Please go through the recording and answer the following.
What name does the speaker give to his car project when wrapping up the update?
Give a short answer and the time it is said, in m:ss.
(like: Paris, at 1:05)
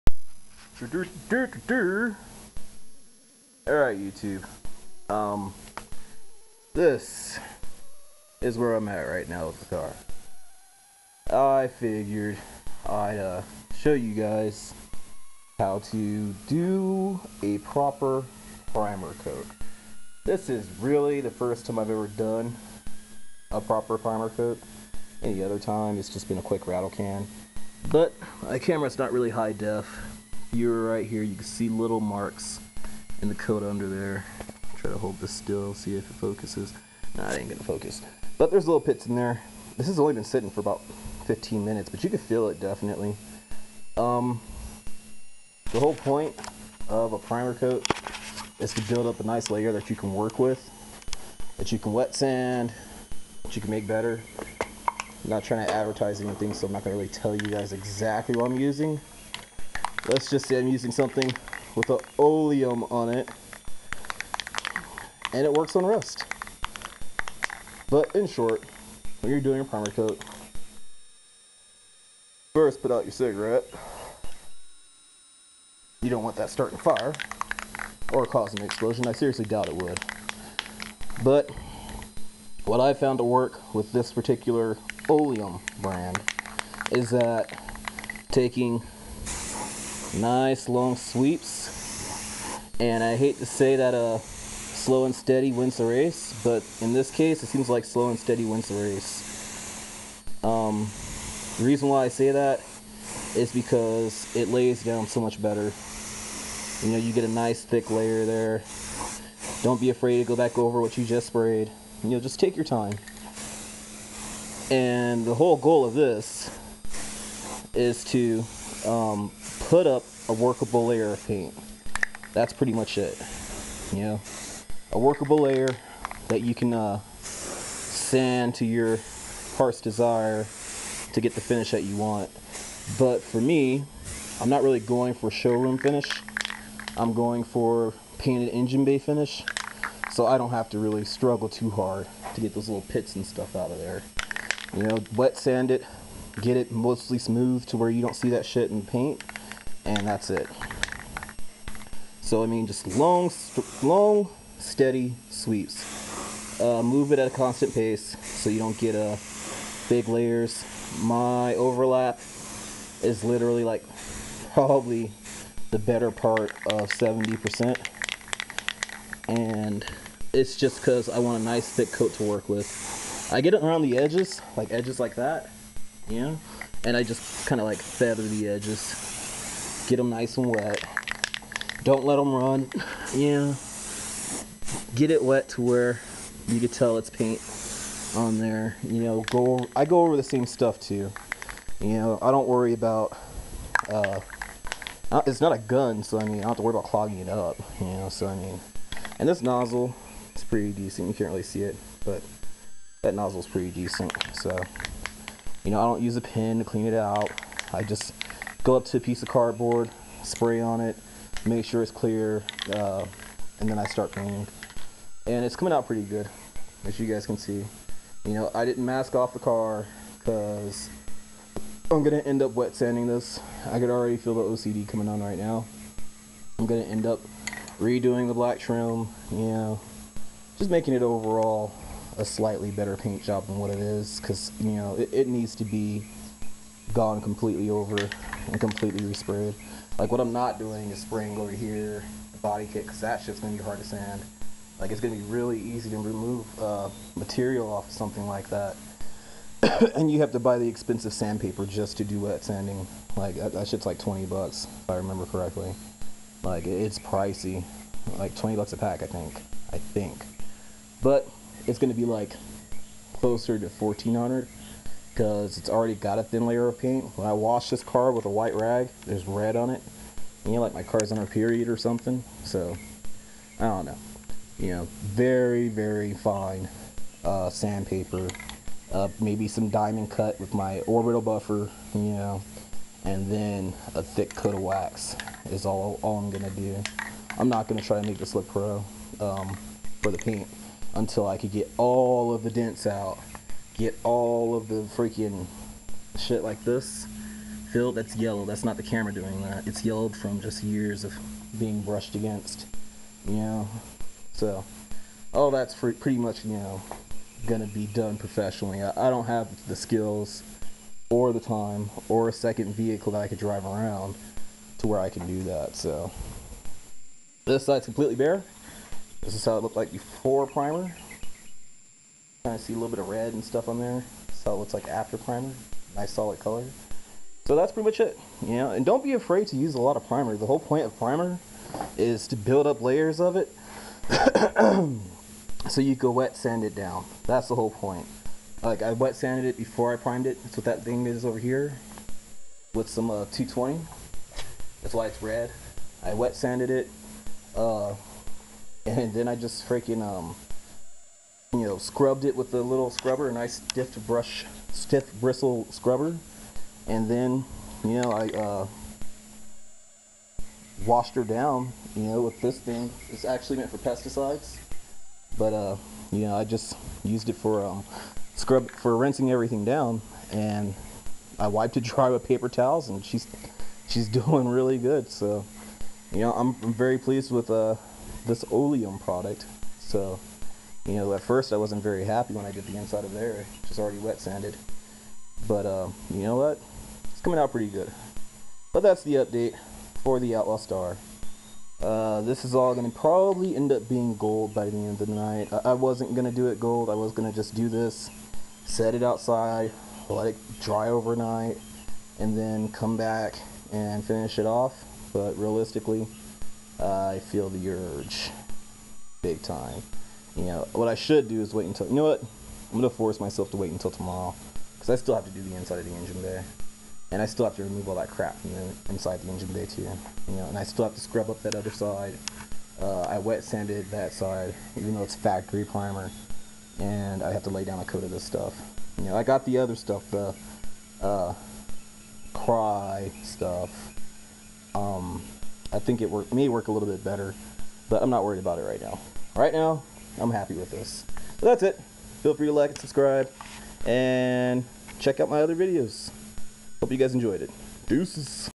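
Outlaw Star, at 6:30.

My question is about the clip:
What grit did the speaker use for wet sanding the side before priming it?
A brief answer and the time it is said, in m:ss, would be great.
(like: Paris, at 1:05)
220, at 5:43.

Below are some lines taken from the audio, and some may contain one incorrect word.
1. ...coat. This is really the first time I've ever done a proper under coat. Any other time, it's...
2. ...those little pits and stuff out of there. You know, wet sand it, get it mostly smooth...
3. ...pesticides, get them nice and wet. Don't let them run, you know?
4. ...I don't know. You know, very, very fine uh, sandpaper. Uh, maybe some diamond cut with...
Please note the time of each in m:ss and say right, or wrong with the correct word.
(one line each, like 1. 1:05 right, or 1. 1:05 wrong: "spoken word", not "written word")
1. 0:19 wrong: "primer", not "under"
2. 2:22 right
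3. 2:58 wrong: "edges", not "pesticides"
4. 4:33 right.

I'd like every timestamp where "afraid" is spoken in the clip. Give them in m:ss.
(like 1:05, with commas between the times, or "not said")
1:49, 5:29.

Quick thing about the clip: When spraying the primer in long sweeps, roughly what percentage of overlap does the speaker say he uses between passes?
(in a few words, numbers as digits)
70%.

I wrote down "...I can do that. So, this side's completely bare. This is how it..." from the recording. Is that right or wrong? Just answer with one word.
right.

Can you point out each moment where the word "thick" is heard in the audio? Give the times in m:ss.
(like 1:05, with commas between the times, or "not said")
1:47, 2:51, 4:44.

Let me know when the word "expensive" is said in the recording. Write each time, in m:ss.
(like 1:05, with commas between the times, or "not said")
4:10.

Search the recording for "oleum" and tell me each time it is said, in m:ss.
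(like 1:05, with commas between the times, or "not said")
1:02, 1:25, 6:18.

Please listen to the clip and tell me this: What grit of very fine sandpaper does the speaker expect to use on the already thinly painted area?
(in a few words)
1400.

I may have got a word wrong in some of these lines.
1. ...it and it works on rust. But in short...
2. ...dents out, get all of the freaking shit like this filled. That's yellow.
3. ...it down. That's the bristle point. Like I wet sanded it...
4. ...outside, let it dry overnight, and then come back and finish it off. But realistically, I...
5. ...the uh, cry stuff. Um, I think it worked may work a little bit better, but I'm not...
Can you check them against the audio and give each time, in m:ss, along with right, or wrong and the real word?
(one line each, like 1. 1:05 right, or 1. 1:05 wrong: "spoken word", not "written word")
1. 1:03 right
2. 4:52 right
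3. 5:36 wrong: "whole", not "bristle"
4. 6:39 right
5. 7:10 right.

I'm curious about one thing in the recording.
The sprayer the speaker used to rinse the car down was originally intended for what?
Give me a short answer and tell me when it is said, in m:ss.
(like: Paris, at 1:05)
pesticides, at 6:03.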